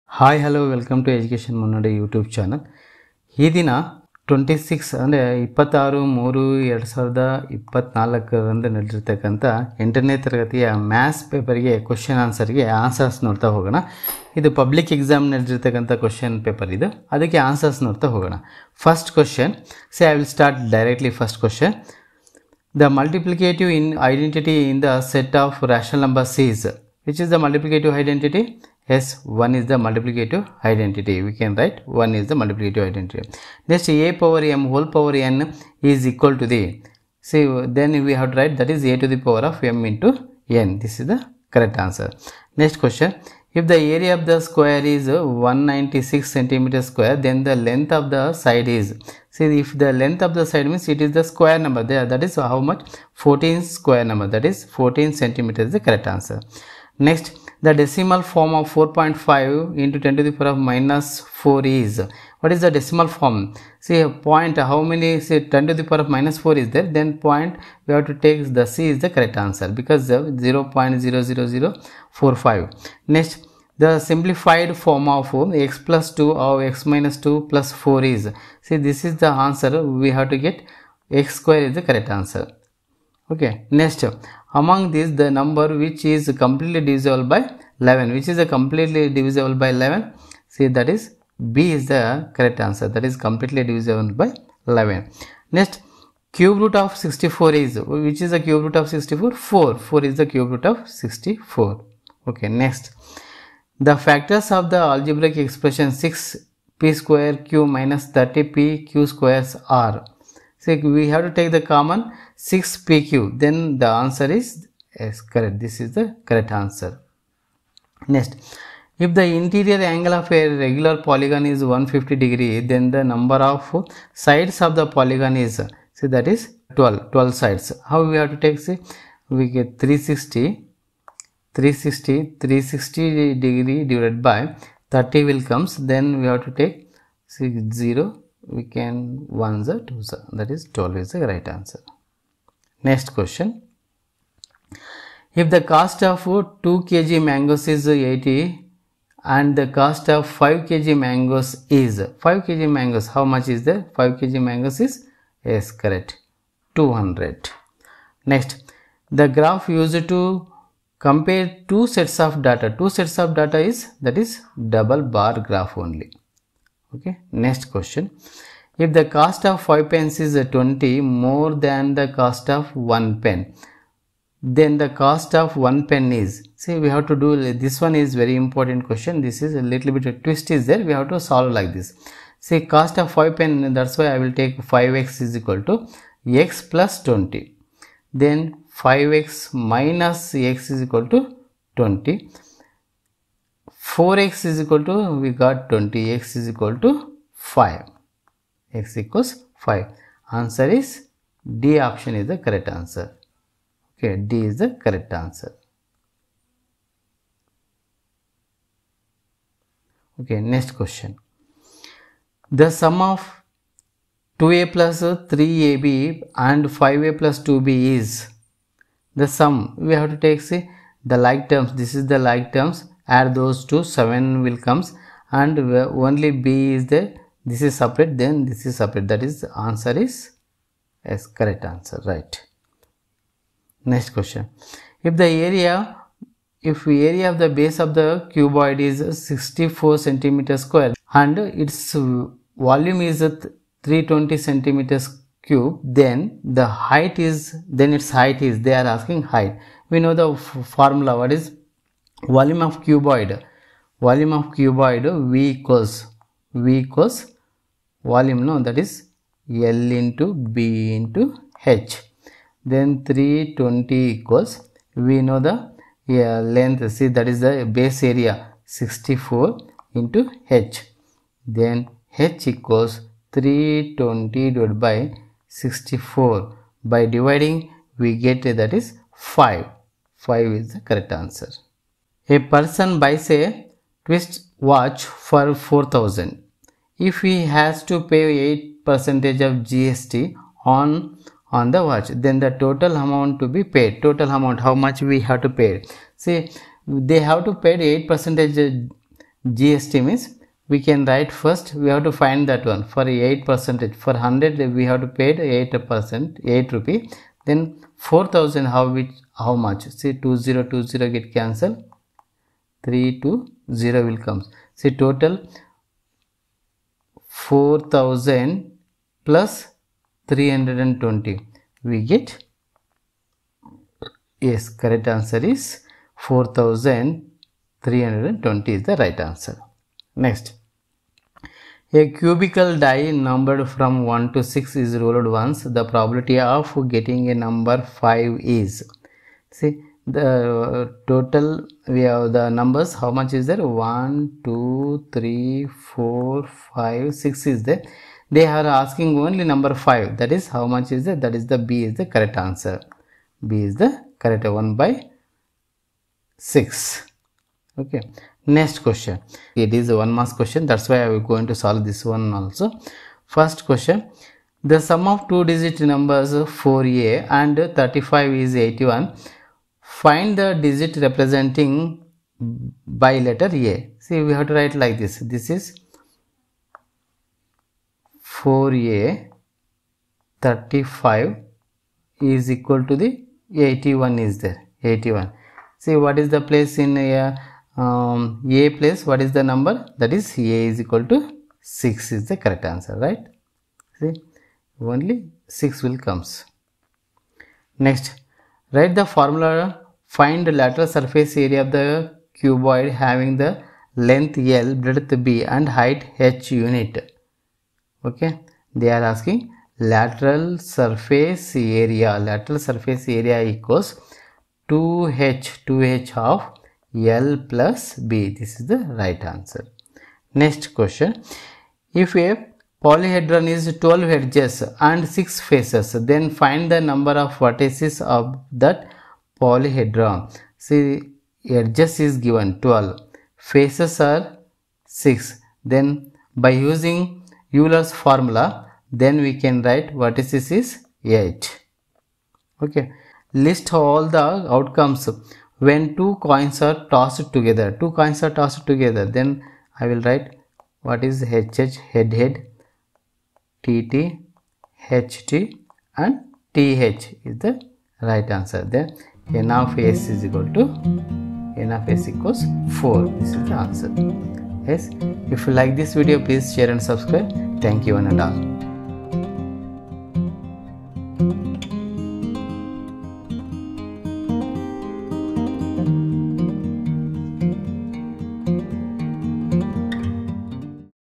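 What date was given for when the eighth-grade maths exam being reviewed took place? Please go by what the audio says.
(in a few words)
26-3-2024.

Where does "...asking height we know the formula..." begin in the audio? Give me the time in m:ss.
4:08.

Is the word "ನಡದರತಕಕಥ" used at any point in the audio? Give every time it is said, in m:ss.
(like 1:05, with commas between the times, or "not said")
0:08, 0:15.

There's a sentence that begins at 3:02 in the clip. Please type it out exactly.
See cost of 5 pen, that's why I will take 5x is equal to x plus 20.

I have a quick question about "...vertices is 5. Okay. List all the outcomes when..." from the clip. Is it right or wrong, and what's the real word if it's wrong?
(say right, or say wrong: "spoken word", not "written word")
wrong: "8", not "5".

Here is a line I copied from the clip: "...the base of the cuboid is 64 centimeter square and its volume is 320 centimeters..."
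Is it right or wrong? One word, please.
right.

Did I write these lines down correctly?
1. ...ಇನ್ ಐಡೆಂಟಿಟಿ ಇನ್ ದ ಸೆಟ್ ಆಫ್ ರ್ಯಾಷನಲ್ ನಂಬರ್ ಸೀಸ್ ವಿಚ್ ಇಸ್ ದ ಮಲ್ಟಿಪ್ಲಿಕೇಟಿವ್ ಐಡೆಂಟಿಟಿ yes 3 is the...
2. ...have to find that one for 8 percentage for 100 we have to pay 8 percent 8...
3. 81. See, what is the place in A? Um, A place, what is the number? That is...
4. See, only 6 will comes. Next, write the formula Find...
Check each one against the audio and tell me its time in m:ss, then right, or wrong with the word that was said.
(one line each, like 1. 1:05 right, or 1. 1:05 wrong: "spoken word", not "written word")
1. 0:23 wrong: "1", not "3"
2. 5:01 right
3. 6:24 right
4. 6:33 right.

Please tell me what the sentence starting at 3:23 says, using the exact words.
Okay, D is the correct answer.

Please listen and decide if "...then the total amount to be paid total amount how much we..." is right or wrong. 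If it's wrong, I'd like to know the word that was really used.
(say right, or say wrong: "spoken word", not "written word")
right.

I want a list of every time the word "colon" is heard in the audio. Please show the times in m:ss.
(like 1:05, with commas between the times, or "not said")
not said.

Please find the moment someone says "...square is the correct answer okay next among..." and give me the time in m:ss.
1:21.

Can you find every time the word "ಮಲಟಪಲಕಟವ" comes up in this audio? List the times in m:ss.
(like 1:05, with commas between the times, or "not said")
0:22, 0:27.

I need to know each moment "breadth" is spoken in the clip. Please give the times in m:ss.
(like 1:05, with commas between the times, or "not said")
6:44.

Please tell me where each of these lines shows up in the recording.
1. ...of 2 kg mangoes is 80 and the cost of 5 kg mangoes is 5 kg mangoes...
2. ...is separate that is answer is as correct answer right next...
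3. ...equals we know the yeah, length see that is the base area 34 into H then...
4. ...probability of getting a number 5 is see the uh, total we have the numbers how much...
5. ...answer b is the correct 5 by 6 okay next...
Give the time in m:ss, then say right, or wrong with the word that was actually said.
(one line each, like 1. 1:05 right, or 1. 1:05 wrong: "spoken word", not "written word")
1. 2:26 right
2. 3:48 right
3. 4:24 wrong: "64", not "34"
4. 5:35 right
5. 5:52 wrong: "1", not "5".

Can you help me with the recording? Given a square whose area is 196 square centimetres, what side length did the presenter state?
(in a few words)
14 centimeters.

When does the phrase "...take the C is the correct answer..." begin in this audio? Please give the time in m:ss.
1:08.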